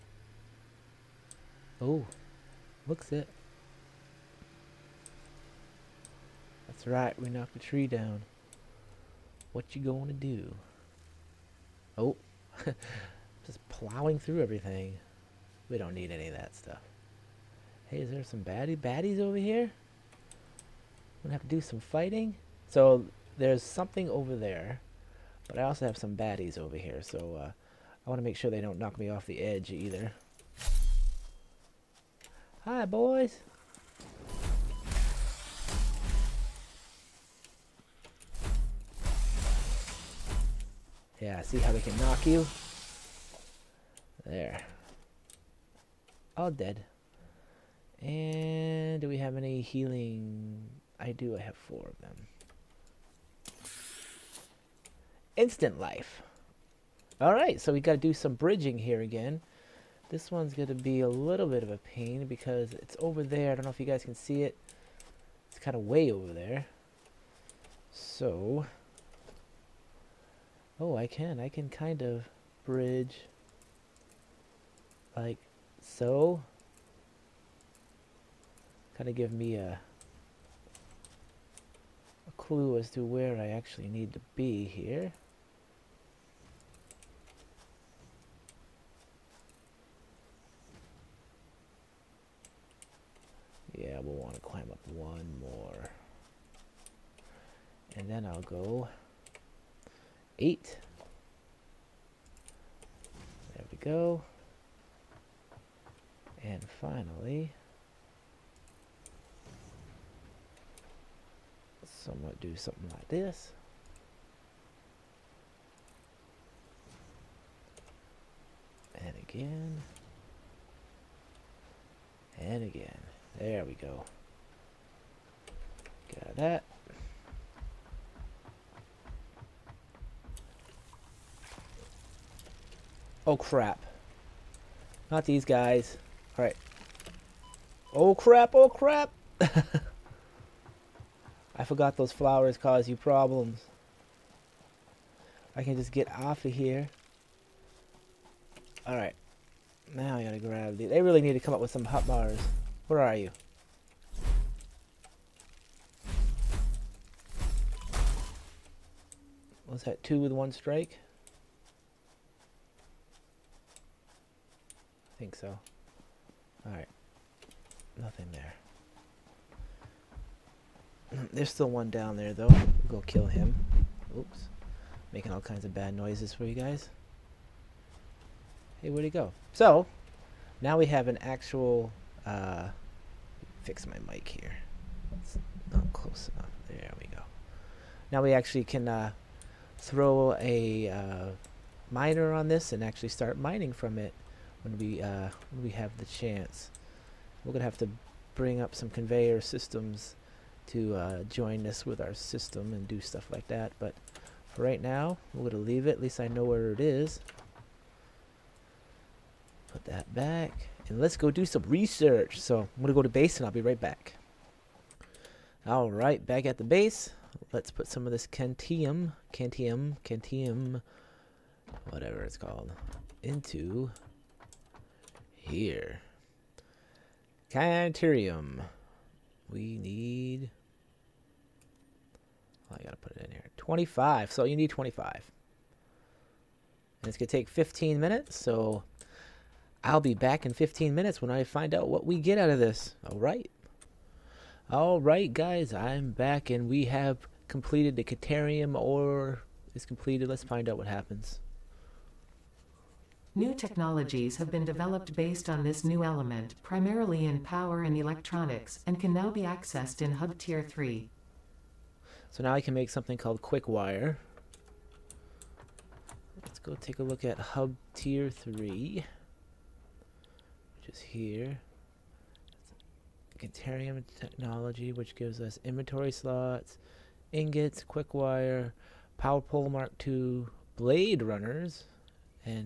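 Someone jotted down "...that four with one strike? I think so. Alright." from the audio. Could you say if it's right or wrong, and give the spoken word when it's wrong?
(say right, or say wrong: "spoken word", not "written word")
wrong: "two", not "four".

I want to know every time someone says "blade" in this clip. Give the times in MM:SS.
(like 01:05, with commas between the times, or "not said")
04:40.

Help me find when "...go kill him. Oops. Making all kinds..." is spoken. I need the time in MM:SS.
02:52.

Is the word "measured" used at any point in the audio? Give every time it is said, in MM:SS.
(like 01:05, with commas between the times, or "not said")
not said.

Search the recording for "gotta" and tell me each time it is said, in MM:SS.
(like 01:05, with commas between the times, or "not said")
02:30, 03:52.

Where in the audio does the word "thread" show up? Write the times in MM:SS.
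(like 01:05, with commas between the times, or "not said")
not said.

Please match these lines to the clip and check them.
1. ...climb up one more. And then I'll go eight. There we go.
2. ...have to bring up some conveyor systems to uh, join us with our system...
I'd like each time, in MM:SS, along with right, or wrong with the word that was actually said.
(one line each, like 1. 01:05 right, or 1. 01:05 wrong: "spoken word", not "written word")
1. 01:34 right
2. 03:17 right.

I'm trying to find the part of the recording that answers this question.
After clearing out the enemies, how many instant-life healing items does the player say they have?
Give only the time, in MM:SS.
00:51.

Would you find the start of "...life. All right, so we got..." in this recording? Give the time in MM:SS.
00:55.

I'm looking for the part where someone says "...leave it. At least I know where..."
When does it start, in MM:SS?
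03:25.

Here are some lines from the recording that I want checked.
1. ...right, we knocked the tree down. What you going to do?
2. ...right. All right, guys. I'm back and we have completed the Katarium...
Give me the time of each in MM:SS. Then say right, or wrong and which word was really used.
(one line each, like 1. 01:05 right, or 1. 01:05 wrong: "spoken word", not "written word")
1. 00:06 right
2. 04:03 right.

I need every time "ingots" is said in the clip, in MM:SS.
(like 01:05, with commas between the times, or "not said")
04:37.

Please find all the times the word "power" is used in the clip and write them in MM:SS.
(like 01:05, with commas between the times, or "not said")
04:17, 04:39.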